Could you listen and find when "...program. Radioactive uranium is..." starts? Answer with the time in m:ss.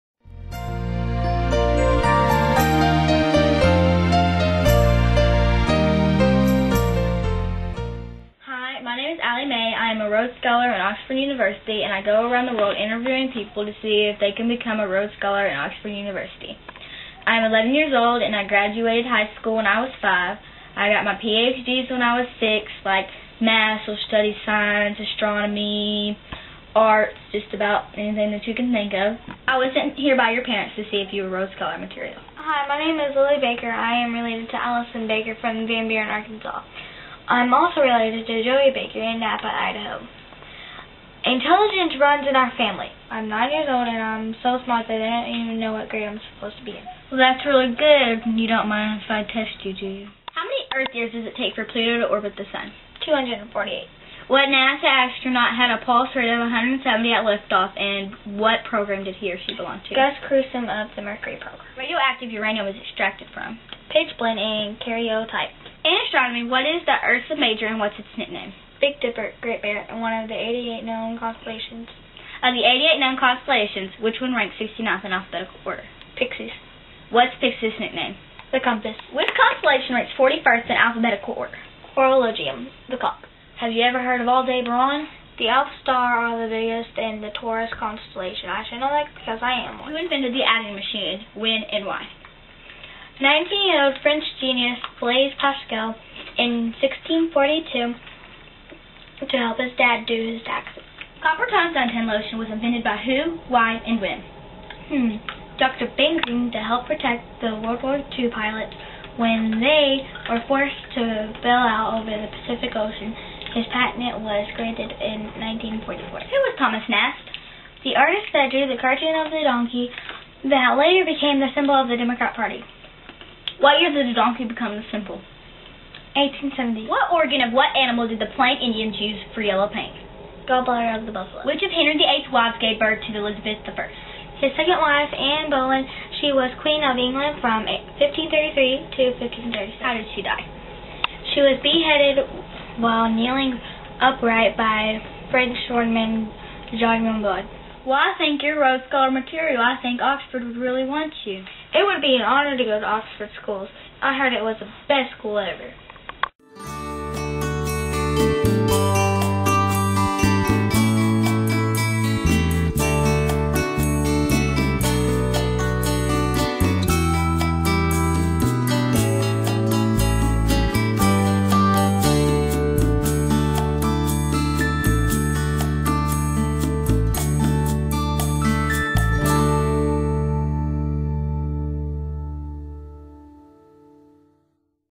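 1:01.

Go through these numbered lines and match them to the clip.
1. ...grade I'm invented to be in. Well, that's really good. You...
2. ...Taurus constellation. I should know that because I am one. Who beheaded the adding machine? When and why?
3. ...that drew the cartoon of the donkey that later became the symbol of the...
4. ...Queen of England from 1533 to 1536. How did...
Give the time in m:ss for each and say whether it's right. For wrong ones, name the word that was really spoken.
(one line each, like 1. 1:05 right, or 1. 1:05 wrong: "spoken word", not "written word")
1. 0:45 wrong: "supposed", not "invented"
2. 1:27 wrong: "invented", not "beheaded"
3. 1:58 right
4. 2:16 right.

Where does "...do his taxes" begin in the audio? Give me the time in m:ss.
1:40.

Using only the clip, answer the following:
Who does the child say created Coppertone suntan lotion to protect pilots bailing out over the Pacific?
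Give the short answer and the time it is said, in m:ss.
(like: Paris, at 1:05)
Dr. Ben Green, at 1:45.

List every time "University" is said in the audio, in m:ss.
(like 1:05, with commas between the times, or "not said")
0:11, 0:15.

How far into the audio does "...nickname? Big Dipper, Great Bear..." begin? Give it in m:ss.
1:08.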